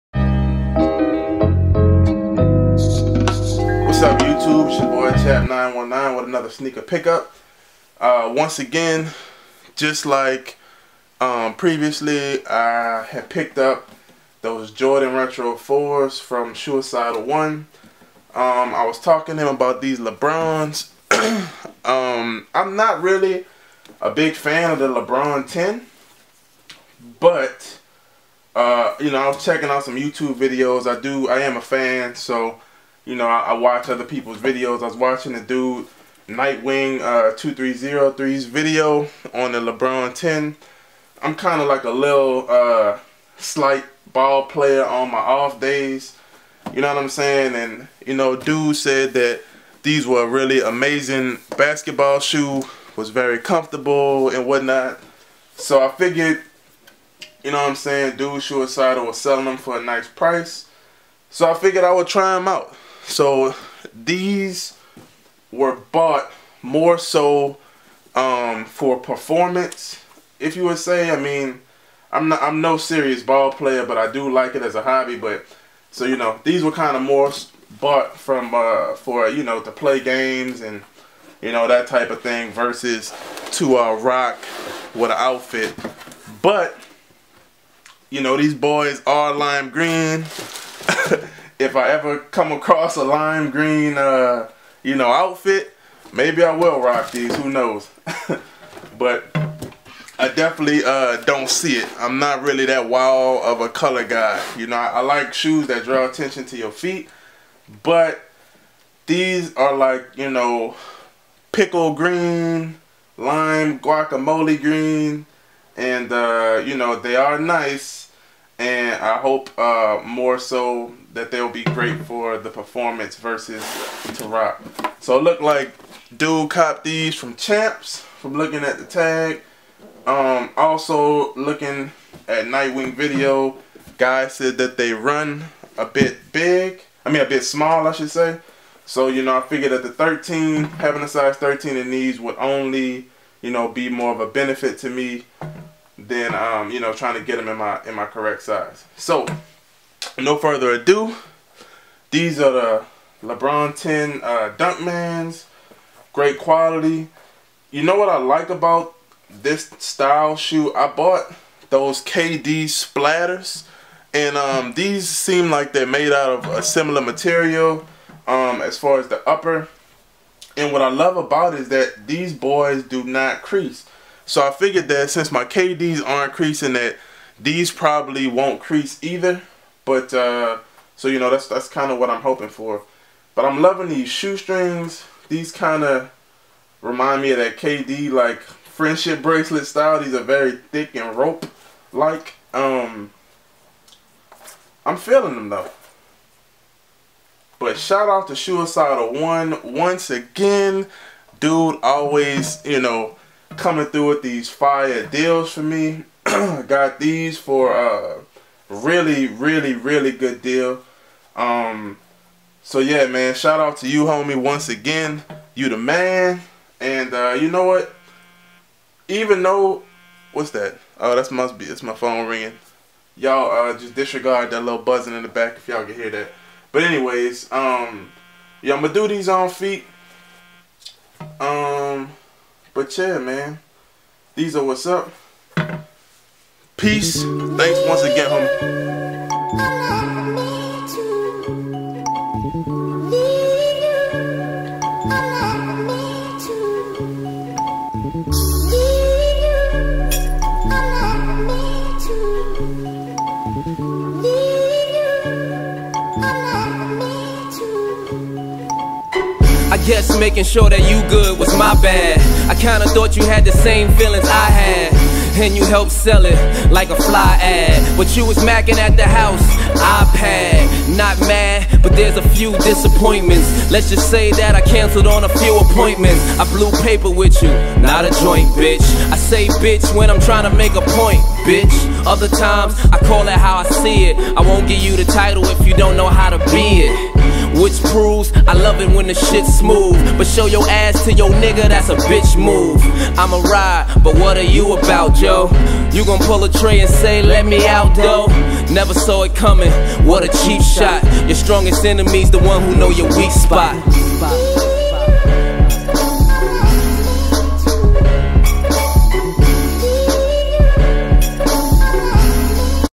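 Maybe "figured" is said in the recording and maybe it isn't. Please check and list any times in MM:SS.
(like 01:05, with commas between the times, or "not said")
00:55, 01:01, 02:19, 02:54.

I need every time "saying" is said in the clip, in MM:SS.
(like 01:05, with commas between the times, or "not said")
00:47, 00:57.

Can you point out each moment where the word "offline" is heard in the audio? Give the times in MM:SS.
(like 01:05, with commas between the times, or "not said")
not said.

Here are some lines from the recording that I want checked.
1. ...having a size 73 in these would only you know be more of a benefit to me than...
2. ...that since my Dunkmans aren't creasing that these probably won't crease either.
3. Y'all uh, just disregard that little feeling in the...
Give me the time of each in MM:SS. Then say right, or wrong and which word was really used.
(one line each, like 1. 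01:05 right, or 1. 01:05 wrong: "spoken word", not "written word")
1. 02:20 wrong: "13", not "73"
2. 02:54 wrong: "KDs", not "Dunkmans"
3. 03:43 wrong: "buzzing", not "feeling".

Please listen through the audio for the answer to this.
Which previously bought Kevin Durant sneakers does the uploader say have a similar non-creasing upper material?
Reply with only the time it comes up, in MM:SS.
02:42.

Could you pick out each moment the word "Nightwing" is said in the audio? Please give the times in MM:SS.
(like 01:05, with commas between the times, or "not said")
00:36, 02:12.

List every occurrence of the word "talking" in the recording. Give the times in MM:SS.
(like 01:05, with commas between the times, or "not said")
00:18.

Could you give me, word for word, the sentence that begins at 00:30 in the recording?
I do, I am a fan, so you know, I, I watch other people's videos.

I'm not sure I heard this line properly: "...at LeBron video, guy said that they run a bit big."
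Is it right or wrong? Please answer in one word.
wrong.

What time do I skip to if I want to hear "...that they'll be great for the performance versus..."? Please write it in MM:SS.
02:01.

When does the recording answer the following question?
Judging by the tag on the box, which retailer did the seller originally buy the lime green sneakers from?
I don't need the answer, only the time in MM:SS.
02:07.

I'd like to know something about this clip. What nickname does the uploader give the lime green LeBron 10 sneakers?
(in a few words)
Dunkmans.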